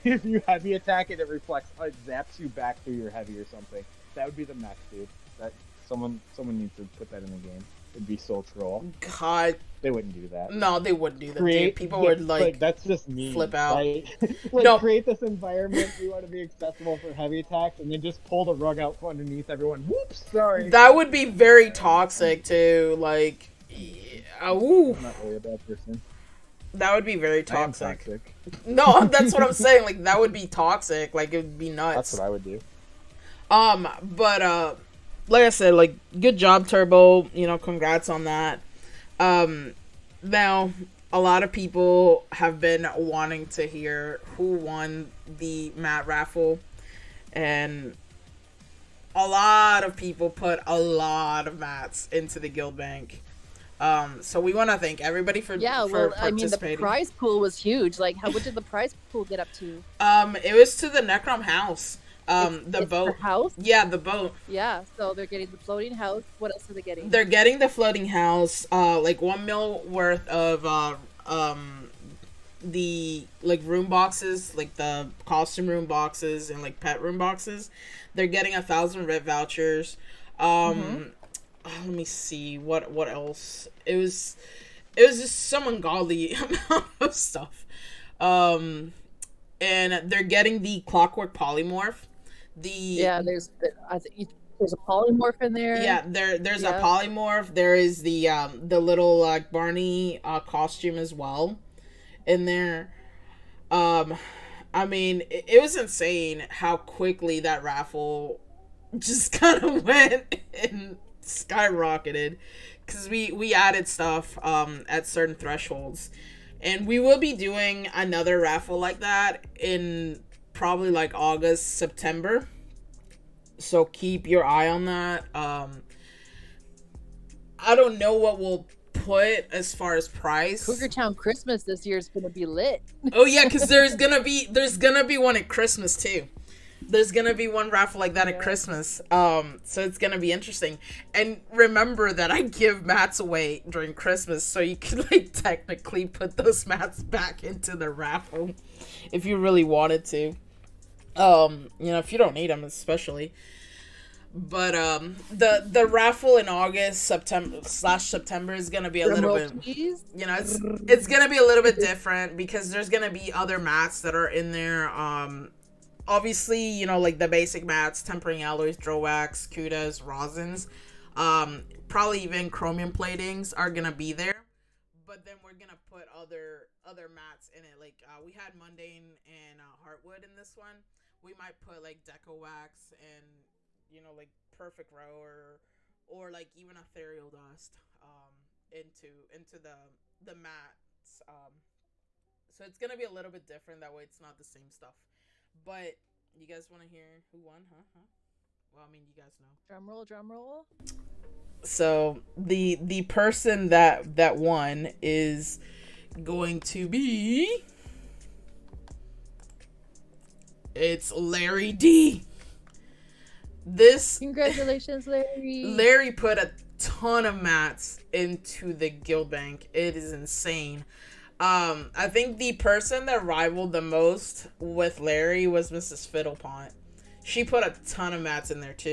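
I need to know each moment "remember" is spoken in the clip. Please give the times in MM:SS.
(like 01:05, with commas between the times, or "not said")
02:21.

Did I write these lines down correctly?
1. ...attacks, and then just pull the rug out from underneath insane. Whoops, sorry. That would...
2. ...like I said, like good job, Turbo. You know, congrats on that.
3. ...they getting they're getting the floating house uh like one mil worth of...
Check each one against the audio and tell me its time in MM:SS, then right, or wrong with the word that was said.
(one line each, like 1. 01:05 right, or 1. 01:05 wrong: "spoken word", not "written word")
1. 00:17 wrong: "everyone", not "insane"
2. 00:35 right
3. 01:06 right.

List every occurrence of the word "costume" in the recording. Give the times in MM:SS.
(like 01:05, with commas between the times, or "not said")
01:15, 01:40.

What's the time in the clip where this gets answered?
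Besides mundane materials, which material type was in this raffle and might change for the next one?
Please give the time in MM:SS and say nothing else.
02:59.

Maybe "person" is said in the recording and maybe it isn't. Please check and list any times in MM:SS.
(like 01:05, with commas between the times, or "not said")
00:25, 03:23, 03:42.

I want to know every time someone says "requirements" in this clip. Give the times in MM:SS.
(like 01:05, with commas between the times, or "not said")
not said.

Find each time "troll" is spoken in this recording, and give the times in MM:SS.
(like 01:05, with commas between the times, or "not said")
00:08.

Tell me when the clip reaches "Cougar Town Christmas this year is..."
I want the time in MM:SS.
02:10.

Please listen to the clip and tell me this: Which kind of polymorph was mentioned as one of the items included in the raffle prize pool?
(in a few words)
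Clockwork.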